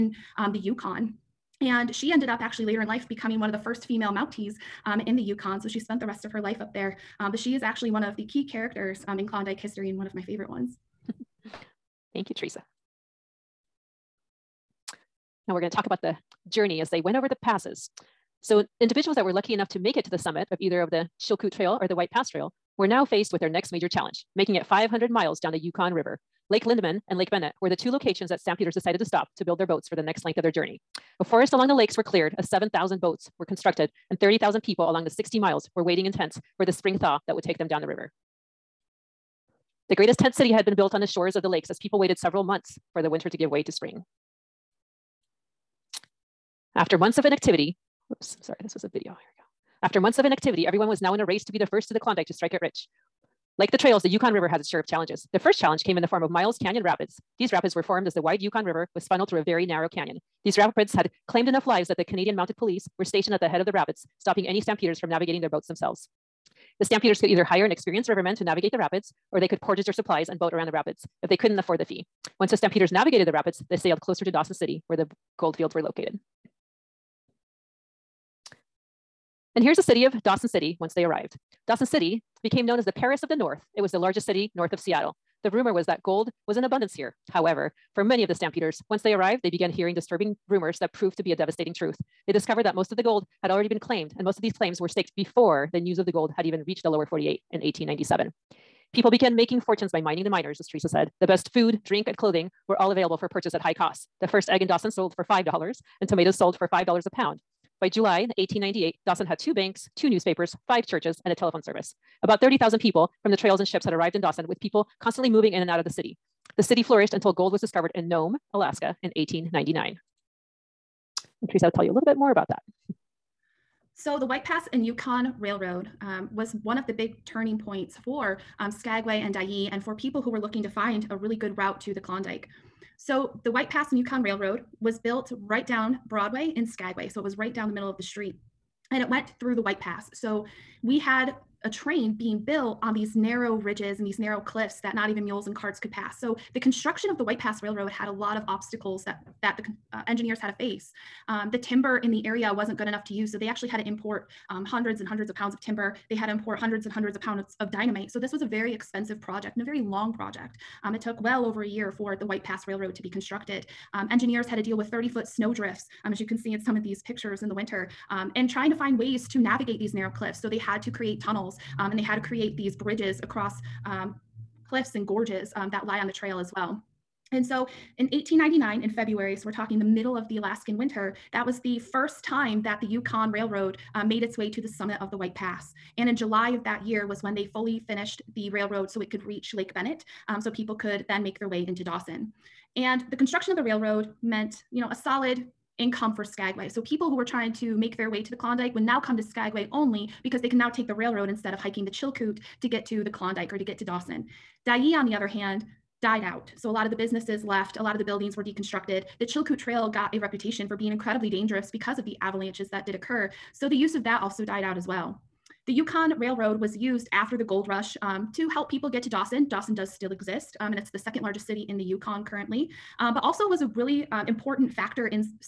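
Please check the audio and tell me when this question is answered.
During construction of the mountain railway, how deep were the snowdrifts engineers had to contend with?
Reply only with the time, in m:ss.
2:44.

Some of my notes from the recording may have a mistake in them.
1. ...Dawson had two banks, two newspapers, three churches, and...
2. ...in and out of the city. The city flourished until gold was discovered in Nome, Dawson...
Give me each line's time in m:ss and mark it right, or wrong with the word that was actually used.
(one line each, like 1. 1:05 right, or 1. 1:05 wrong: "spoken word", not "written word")
1. 1:49 wrong: "five", not "three"
2. 1:55 wrong: "Alaska", not "Dawson".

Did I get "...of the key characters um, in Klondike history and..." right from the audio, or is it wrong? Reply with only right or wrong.
right.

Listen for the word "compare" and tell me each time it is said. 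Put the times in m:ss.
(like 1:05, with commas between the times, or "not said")
not said.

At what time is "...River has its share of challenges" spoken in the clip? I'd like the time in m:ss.
0:54.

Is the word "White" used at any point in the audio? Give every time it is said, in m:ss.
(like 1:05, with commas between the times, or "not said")
0:21, 2:04, 2:13, 2:19, 2:27, 2:42, 3:05.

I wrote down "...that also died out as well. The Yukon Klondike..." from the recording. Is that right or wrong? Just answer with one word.
wrong.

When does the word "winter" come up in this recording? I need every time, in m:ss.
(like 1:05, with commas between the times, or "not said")
0:43, 2:47, 3:00.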